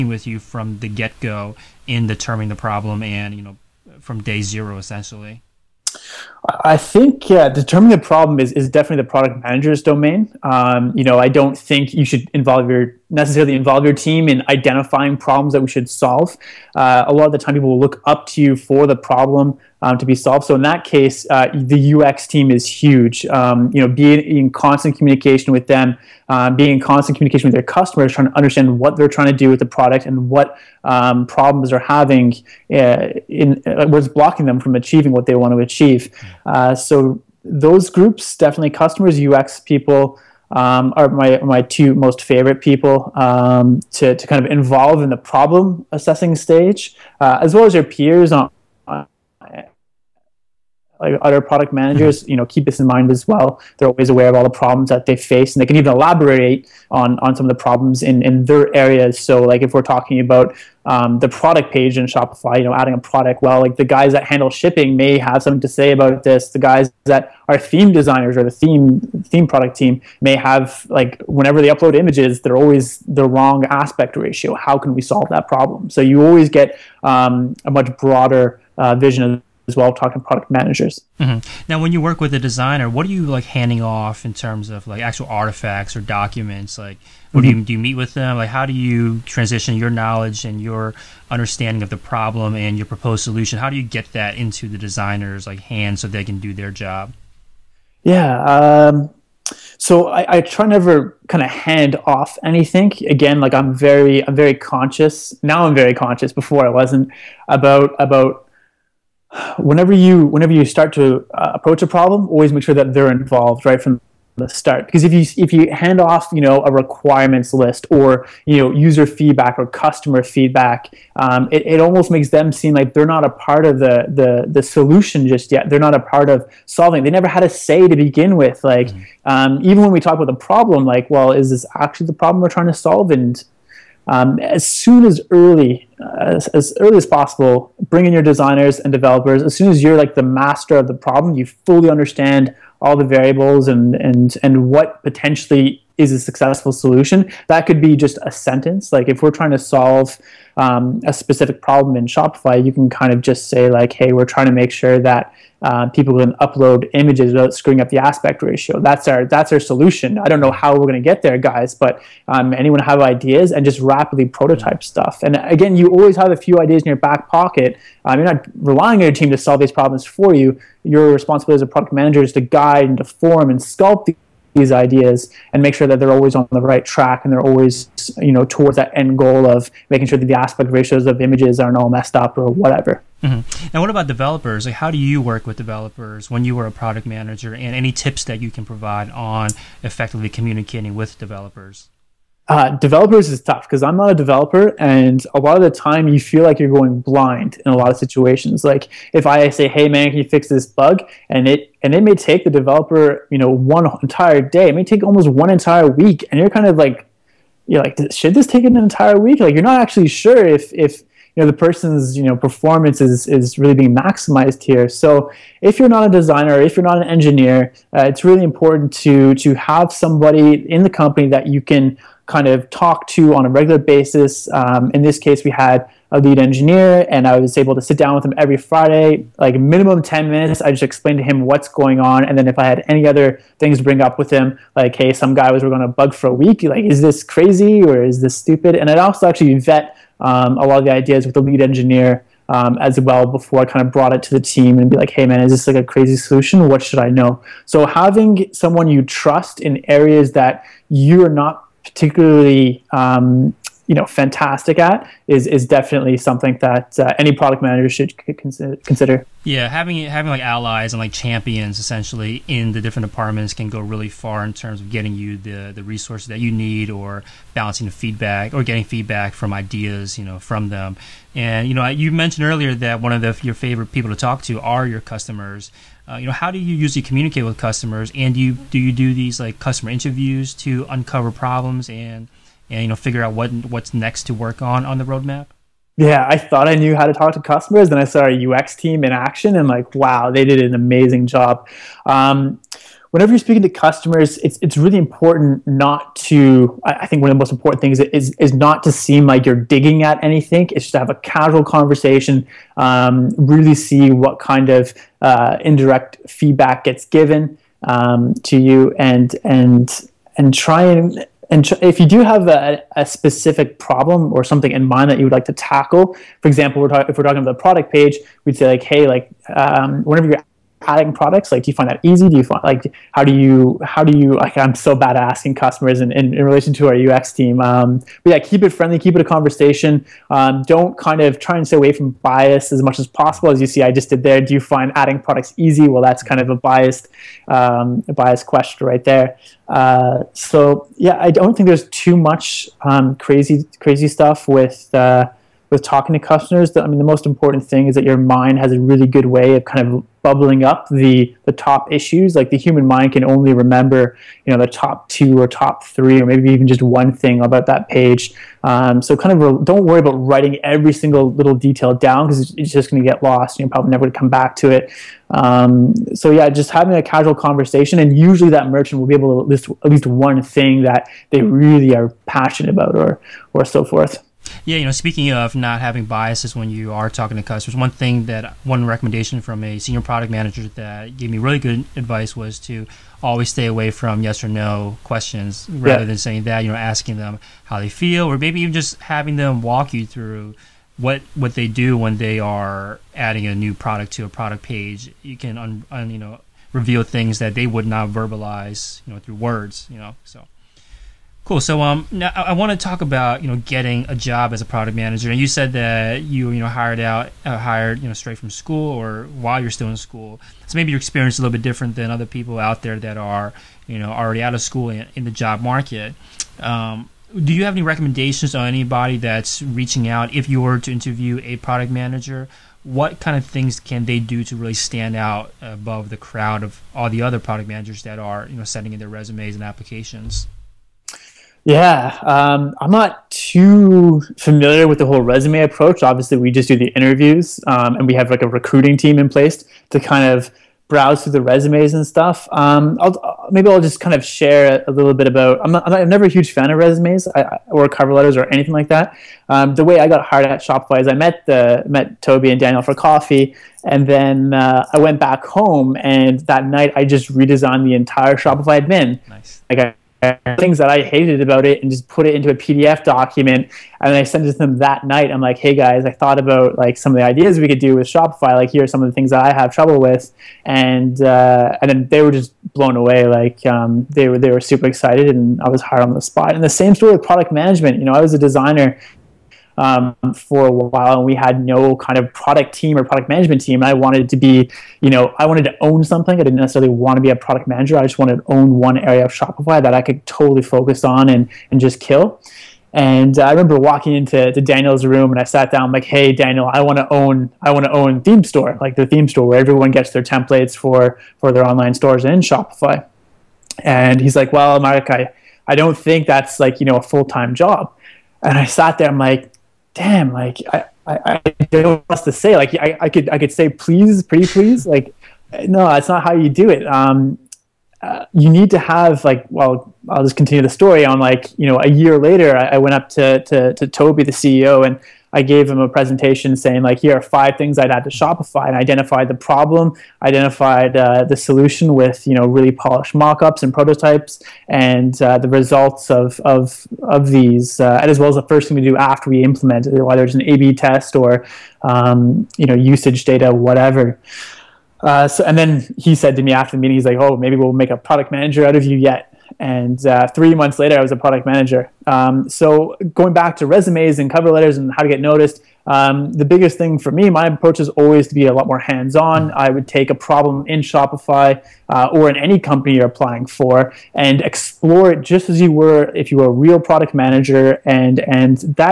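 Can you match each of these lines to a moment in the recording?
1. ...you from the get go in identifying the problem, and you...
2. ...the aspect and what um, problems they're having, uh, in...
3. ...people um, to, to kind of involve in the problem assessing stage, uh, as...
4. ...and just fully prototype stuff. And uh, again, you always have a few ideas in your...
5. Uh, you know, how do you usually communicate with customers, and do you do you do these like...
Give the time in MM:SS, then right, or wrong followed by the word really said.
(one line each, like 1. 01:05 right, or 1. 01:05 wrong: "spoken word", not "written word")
1. 00:00 wrong: "determining", not "identifying"
2. 00:29 wrong: "product", not "aspect"
3. 00:42 right
4. 02:43 wrong: "rapidly", not "fully"
5. 04:36 right.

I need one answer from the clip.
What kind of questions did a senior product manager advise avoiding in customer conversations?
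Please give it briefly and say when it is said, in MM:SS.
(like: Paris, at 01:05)
yes or no questions, at 06:24.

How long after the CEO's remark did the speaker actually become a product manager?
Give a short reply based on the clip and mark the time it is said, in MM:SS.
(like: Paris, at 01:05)
3 months, at 09:10.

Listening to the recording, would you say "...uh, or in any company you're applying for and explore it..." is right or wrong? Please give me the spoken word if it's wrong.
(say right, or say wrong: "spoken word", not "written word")
right.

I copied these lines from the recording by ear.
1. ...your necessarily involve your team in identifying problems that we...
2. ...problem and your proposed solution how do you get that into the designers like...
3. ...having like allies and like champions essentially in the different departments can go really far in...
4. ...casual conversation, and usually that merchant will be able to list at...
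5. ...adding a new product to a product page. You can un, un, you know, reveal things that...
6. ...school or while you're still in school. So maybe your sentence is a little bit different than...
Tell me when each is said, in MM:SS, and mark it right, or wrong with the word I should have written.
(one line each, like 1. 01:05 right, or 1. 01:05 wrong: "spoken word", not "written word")
1. 00:12 right
2. 01:31 right
3. 04:20 right
4. 06:07 right
5. 06:33 right
6. 06:48 wrong: "experience", not "sentence".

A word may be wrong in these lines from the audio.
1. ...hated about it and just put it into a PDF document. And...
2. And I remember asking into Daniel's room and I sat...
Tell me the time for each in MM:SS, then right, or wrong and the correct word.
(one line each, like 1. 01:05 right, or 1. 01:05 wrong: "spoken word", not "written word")
1. 07:41 right
2. 08:12 wrong: "walking", not "asking".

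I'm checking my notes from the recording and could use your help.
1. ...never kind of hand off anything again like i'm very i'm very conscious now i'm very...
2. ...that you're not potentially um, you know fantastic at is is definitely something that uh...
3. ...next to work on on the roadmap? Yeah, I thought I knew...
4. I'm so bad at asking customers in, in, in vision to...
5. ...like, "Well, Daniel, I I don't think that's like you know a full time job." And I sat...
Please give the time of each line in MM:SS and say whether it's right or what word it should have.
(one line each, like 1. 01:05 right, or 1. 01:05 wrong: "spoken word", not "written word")
1. 01:40 right
2. 04:10 wrong: "particularly", not "potentially"
3. 04:43 right
4. 05:24 wrong: "relation", not "vision"
5. 08:24 wrong: "Mark", not "Daniel".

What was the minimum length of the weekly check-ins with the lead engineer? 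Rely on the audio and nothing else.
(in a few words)
10 minutes.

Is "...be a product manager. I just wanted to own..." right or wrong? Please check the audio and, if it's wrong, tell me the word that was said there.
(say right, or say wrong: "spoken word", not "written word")
right.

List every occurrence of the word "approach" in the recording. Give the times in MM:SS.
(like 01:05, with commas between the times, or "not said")
01:51, 07:15, 09:17.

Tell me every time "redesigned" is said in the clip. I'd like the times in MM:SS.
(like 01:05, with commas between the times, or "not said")
07:37.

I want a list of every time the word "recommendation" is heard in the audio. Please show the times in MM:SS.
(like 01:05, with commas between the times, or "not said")
06:18, 06:57.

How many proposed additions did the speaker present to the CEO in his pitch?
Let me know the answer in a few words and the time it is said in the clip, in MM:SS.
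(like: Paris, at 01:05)
5, at 08:47.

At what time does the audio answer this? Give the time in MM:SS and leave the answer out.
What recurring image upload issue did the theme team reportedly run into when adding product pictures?
01:13.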